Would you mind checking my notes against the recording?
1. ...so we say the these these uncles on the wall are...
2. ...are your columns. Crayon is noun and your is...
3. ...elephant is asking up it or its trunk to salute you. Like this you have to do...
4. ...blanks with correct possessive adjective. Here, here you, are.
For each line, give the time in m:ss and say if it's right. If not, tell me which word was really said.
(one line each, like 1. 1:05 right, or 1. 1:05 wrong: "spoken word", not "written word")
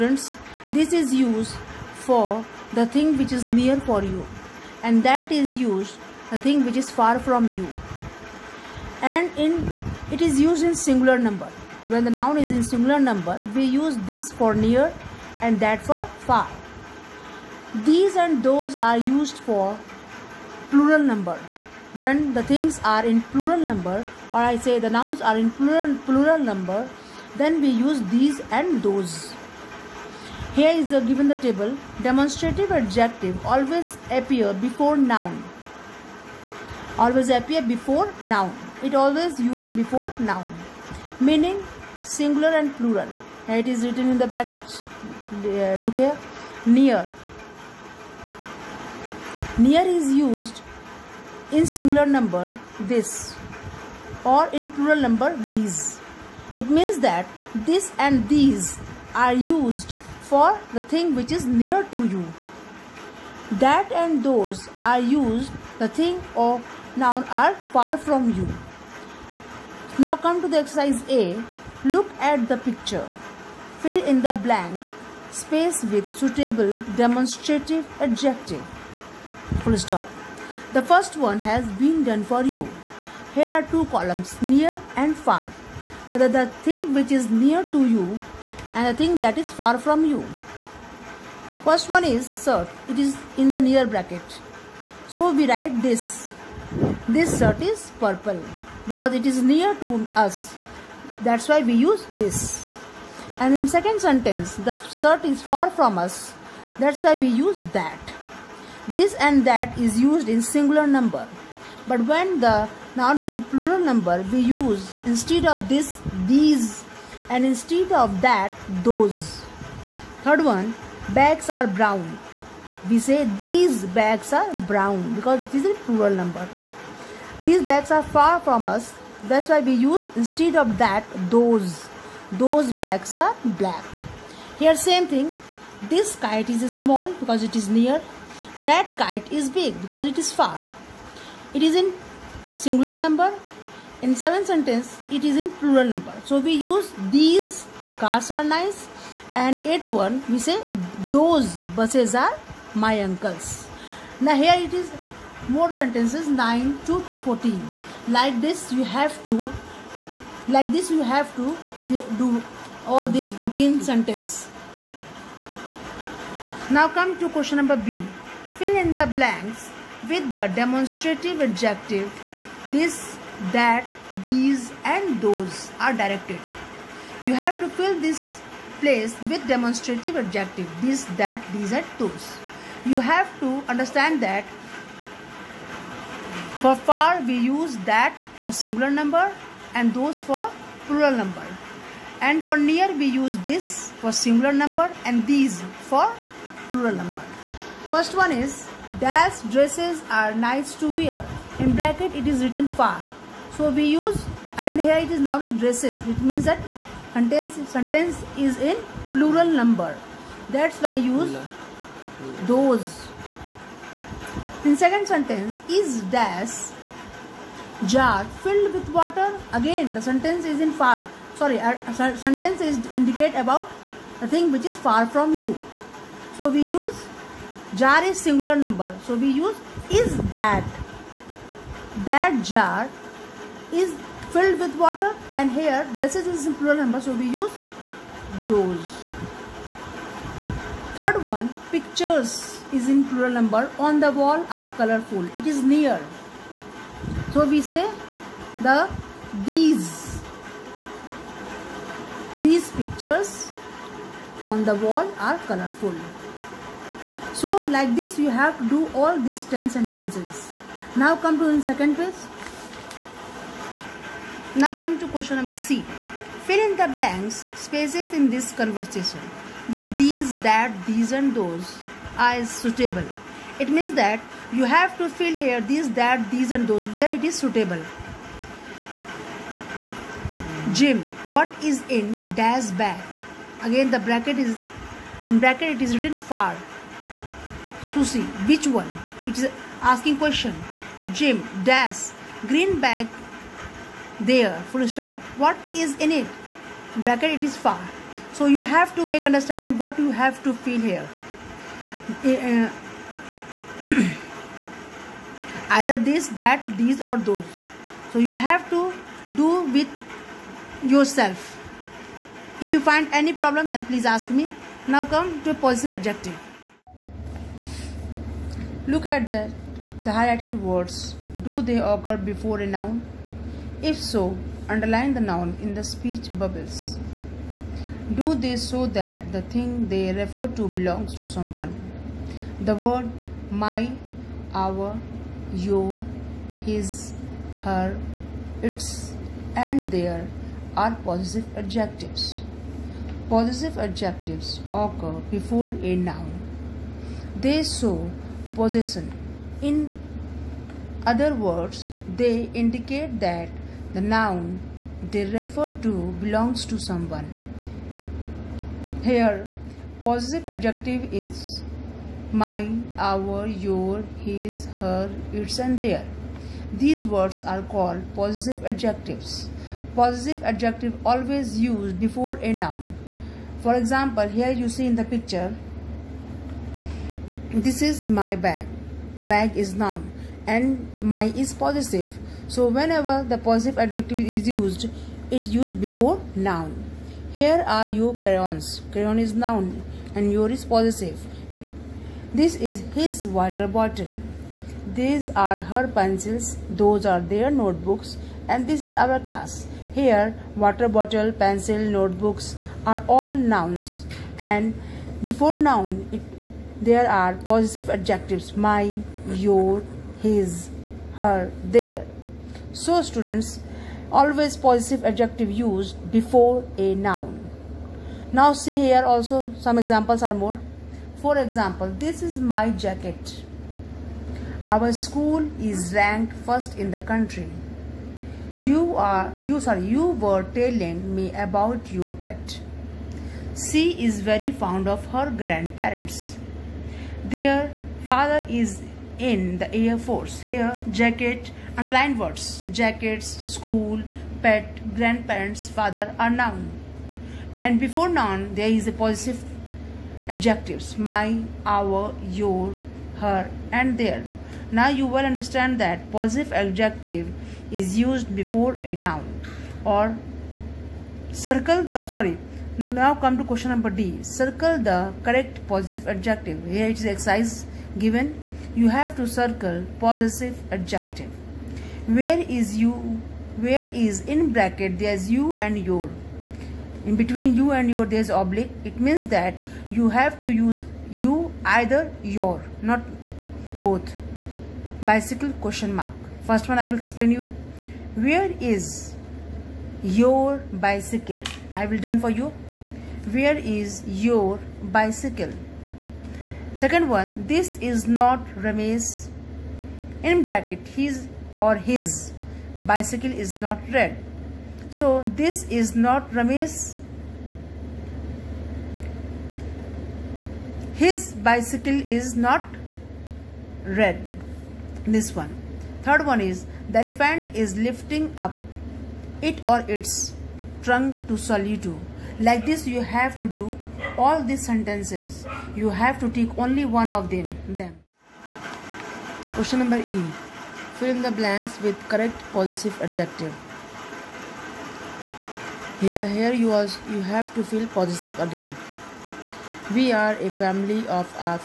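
1. 4:07 wrong: "pictures", not "uncles"
2. 6:27 wrong: "crayons", not "columns"
3. 8:36 wrong: "lifting", not "asking"
4. 8:51 right.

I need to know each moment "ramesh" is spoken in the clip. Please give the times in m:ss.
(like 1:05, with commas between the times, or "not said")
8:18, 8:26.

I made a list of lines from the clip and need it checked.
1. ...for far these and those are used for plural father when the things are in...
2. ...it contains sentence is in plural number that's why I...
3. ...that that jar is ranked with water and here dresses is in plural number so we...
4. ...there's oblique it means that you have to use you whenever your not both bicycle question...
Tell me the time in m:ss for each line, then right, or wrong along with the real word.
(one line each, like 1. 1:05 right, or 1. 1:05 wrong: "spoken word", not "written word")
1. 0:15 wrong: "number", not "father"
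2. 3:26 right
3. 3:50 wrong: "filled", not "ranked"
4. 7:58 wrong: "either", not "whenever".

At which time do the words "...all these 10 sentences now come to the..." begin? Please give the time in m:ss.
4:18.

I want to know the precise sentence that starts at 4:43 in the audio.
Again the bracket is in bracket it is written far.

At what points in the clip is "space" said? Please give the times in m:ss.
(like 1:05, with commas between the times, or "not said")
1:15, 4:27.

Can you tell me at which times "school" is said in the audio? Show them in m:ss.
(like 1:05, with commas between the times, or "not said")
7:04, 7:23.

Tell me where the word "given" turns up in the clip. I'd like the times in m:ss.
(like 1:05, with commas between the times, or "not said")
0:31, 7:47.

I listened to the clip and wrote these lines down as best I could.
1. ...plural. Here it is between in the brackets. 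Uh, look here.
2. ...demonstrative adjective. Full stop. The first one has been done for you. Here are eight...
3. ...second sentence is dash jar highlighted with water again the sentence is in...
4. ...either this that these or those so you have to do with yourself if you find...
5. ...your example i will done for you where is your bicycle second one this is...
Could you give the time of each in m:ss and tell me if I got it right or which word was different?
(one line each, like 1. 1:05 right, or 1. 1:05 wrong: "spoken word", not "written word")
1. 0:42 wrong: "written", not "between"
2. 1:17 wrong: "two", not "eight"
3. 3:34 wrong: "filled", not "highlighted"
4. 5:05 right
5. 8:10 wrong: "bicycle", not "example".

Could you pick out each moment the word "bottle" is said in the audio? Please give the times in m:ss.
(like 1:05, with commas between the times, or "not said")
6:33, 6:40.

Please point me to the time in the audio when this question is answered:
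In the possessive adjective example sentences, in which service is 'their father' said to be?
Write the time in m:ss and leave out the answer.
7:17.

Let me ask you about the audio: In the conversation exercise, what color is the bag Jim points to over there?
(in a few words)
Green.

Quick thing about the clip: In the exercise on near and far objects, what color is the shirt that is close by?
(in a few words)
Purple.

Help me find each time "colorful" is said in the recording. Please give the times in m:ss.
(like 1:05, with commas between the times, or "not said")
4:04, 4:15.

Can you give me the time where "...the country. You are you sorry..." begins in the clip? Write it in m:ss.
7:06.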